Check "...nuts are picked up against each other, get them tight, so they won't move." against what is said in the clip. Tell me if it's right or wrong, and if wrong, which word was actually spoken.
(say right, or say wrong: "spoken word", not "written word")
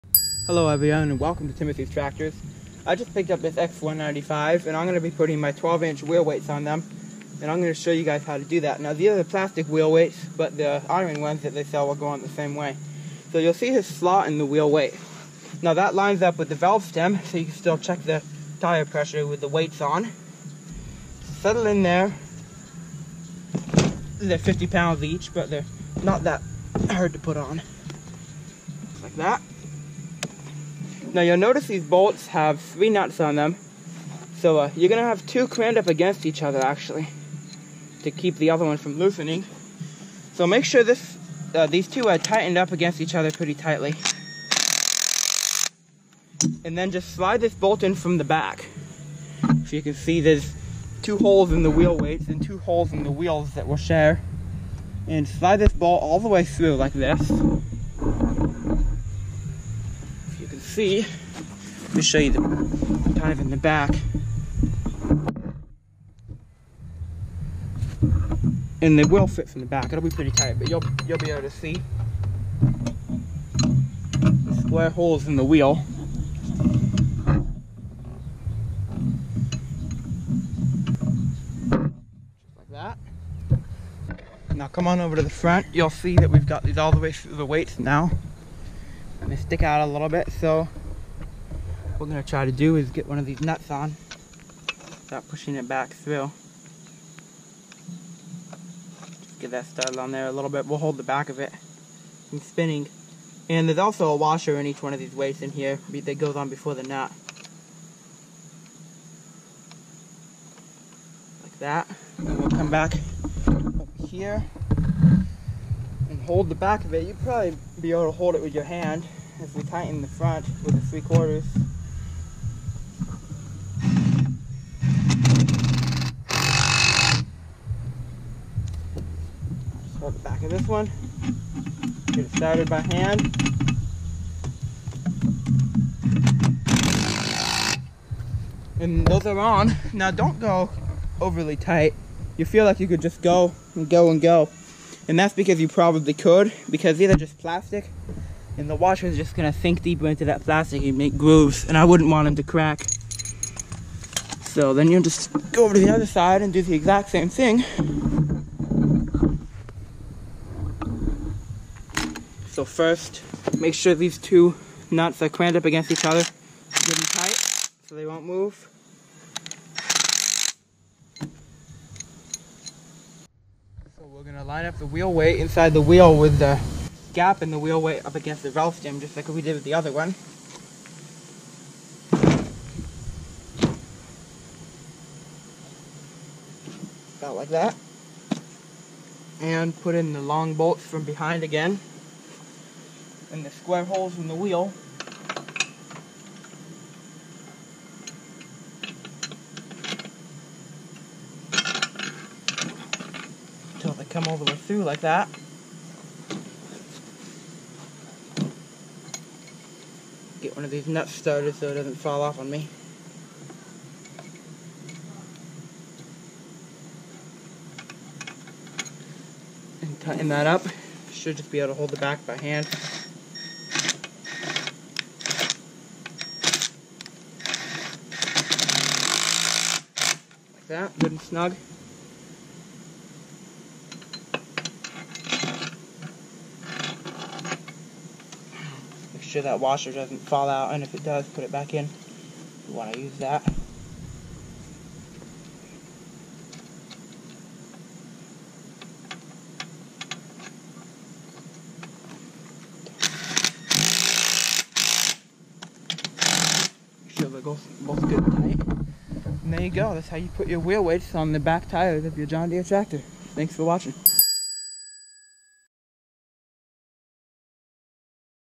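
wrong: "crammed", not "picked".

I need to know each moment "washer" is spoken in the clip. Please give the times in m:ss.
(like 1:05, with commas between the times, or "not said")
1:44, 2:28, 3:59.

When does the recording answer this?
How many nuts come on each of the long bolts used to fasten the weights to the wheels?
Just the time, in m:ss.
0:32.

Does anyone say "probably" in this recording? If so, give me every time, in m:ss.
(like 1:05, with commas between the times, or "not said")
1:57, 2:25.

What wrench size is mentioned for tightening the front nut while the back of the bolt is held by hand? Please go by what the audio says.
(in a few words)
3/4.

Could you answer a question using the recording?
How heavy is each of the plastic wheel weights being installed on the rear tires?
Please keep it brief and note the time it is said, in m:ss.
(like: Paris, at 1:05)
50 pounds, at 0:24.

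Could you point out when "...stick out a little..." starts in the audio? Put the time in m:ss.
1:29.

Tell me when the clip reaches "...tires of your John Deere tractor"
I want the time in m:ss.
4:21.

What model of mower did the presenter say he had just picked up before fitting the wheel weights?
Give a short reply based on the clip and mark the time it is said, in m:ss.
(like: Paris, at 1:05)
X195, at 0:03.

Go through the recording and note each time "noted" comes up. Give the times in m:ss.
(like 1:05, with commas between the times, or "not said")
not said.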